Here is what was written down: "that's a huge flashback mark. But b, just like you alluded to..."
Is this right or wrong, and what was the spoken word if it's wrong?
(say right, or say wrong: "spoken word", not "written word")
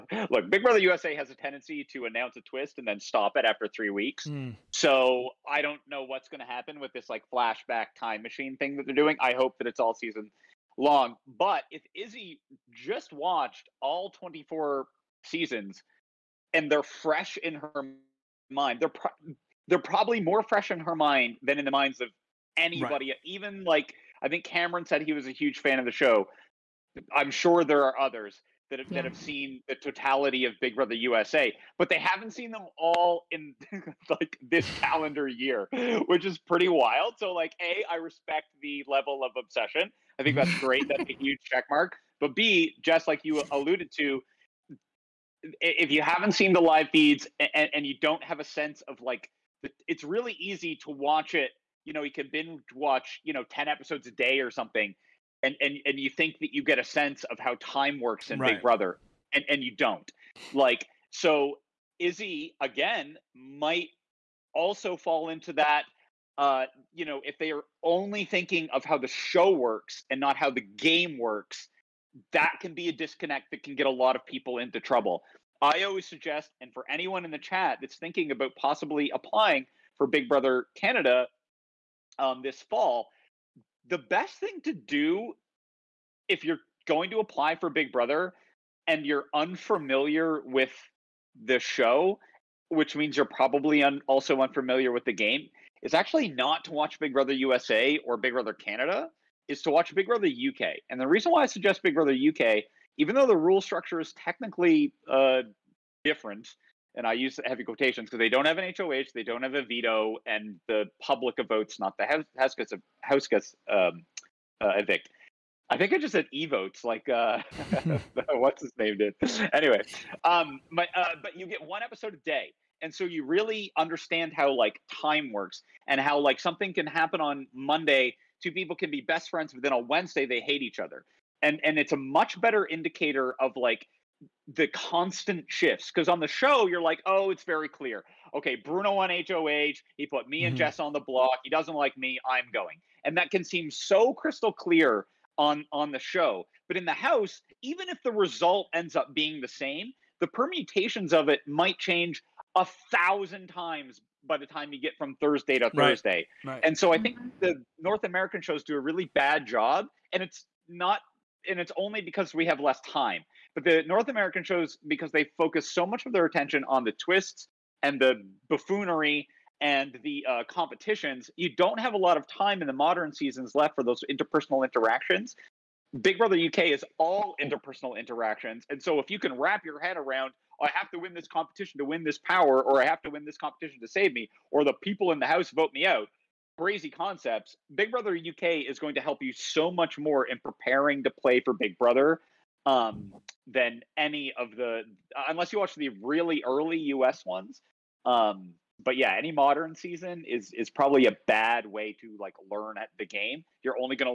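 wrong: "check", not "flashback".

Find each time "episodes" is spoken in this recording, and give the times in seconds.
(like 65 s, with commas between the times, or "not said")
53 s, 121 s.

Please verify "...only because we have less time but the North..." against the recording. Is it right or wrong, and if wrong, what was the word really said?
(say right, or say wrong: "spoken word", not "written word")
right.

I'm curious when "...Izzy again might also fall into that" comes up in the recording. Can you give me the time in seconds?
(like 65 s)
61 s.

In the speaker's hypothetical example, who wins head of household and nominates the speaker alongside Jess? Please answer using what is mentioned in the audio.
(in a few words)
Bruno.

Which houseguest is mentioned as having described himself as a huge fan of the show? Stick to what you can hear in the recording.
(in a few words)
Cameron.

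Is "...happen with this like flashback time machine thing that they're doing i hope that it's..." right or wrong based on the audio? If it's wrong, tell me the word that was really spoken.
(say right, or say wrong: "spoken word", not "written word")
right.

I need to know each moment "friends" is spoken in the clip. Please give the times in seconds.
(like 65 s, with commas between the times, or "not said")
129 s.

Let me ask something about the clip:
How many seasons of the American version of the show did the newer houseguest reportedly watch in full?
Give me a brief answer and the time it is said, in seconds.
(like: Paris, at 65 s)
24, at 14 s.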